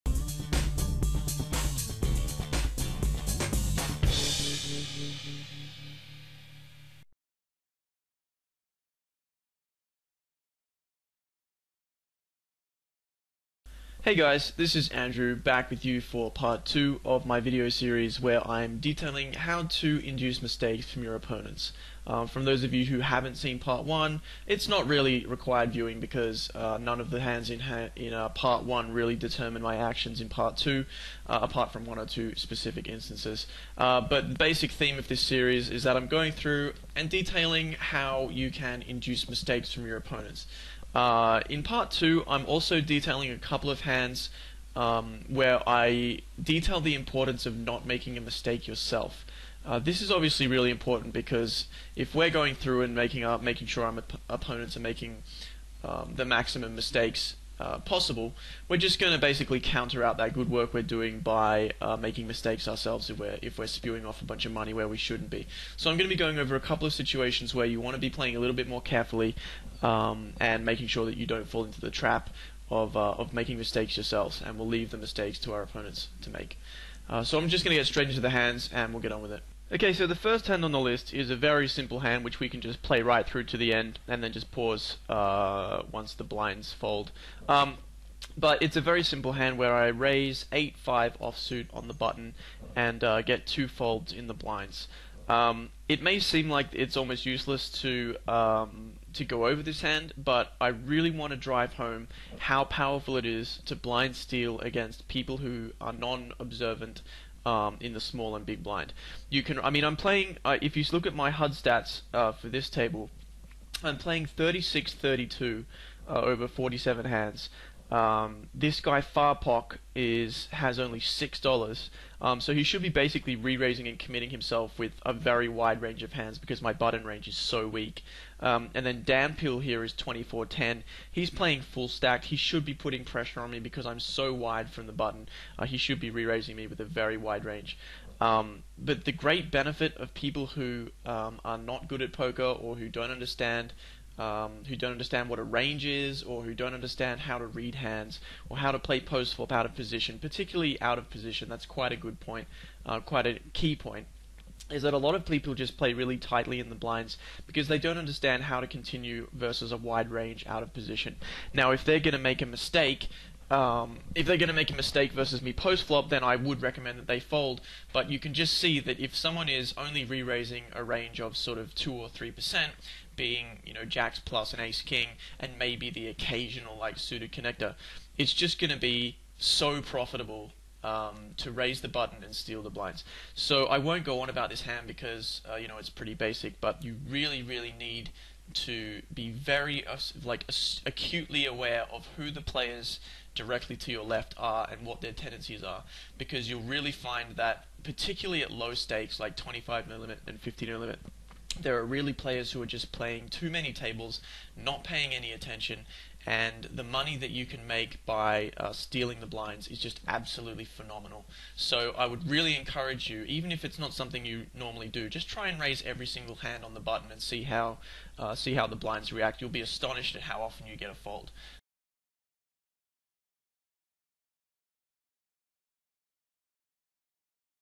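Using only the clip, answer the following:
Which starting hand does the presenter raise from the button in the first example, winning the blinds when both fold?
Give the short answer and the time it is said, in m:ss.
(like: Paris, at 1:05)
8-5 offsuit, at 1:30.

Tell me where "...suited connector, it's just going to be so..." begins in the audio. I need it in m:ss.
2:56.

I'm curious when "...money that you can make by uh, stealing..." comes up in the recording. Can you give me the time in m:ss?
3:26.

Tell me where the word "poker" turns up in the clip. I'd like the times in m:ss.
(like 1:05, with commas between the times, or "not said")
2:22.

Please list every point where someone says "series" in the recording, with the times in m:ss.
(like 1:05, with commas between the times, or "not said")
0:17, 0:35.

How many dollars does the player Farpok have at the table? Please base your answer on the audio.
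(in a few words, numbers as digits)
$6.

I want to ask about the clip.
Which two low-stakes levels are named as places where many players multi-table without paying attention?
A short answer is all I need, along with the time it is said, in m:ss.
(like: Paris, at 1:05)
25 and 50, at 3:19.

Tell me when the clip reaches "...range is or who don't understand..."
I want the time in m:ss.
2:25.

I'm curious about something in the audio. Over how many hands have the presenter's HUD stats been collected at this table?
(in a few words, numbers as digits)
47.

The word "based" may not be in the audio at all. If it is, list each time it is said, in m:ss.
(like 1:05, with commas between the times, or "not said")
not said.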